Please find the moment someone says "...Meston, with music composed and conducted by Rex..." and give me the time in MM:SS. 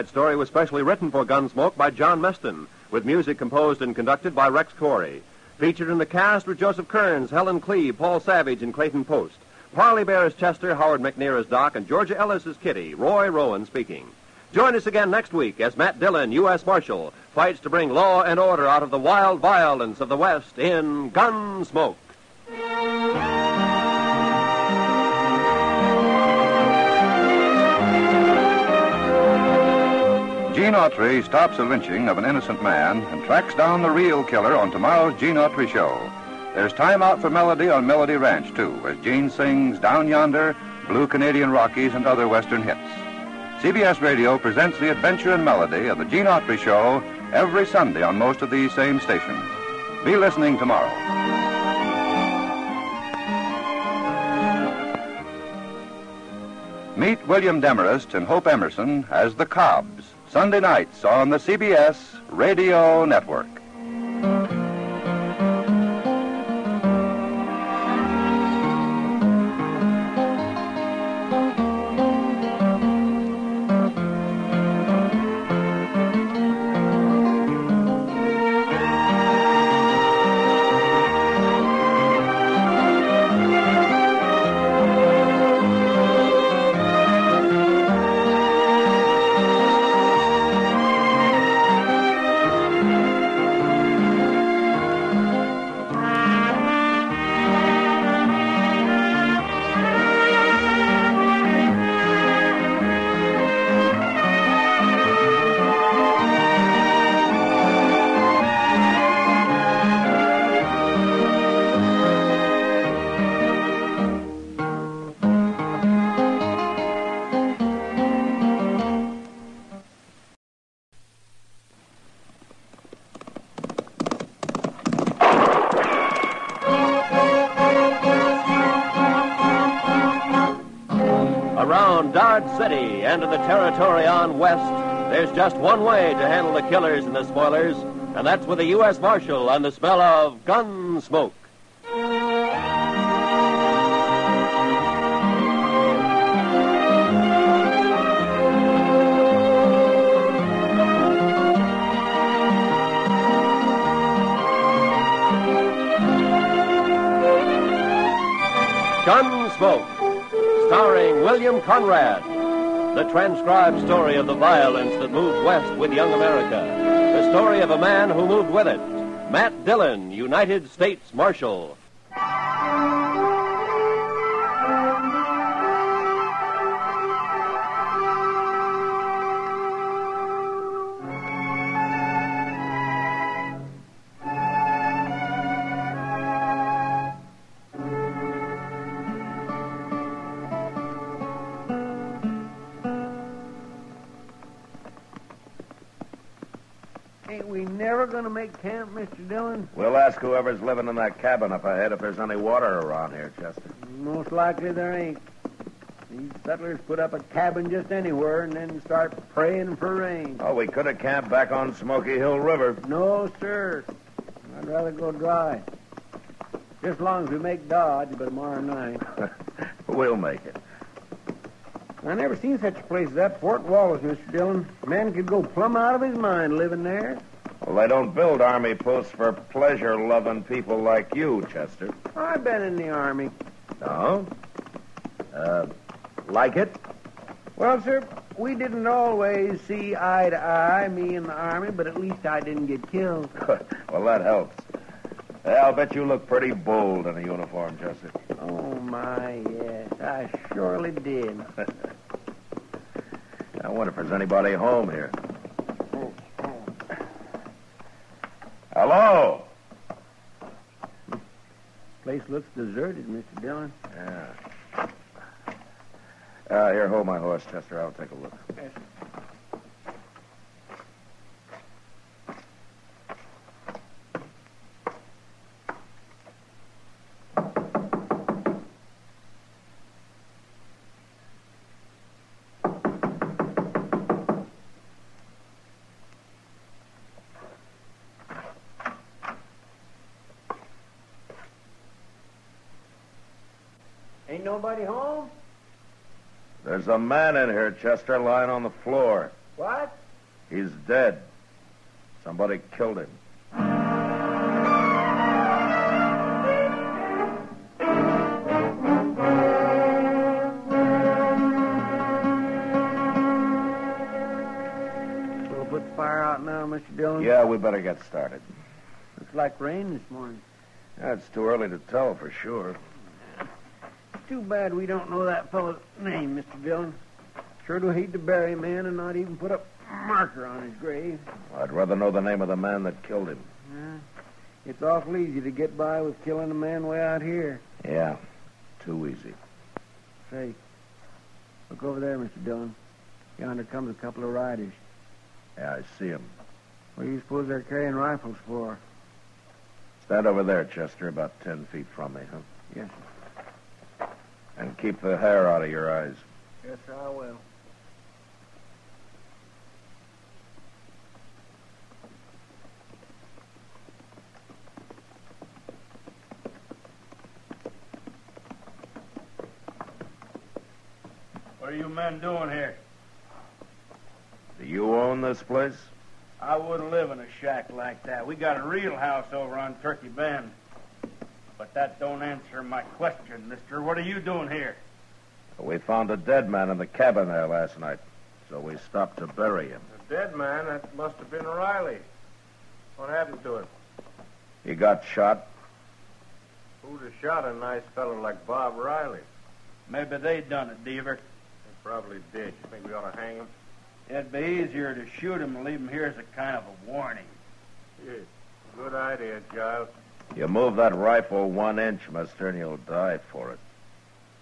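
00:02.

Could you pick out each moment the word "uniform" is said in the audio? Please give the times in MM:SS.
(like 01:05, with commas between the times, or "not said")
04:07.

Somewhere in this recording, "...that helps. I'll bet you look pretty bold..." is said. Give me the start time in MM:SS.
04:04.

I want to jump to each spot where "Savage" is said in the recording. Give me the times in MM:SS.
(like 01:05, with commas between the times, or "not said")
00:08.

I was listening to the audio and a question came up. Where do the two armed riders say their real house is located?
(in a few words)
Turkey Bend.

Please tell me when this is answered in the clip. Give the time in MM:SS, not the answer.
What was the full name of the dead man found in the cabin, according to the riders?
06:38.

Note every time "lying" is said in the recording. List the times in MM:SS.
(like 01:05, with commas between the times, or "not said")
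04:58.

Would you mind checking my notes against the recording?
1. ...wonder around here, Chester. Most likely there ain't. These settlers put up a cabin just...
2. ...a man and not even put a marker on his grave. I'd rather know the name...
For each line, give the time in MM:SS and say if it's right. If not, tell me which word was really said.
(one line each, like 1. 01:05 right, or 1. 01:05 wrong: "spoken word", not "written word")
1. 03:22 wrong: "water", not "wonder"
2. 05:28 right.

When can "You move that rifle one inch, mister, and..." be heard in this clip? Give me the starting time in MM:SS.
06:50.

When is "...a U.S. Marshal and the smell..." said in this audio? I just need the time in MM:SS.
02:18.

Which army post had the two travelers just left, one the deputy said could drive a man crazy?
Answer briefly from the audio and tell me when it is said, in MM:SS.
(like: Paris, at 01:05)
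Fort Wallace, at 03:43.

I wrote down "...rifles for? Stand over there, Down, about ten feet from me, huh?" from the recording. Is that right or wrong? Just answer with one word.
wrong.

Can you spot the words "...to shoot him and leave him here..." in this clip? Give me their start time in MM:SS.
06:44.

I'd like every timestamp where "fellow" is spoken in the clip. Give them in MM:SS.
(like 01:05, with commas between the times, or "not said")
05:25, 06:37.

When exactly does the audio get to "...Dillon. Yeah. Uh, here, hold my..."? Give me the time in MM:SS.
04:23.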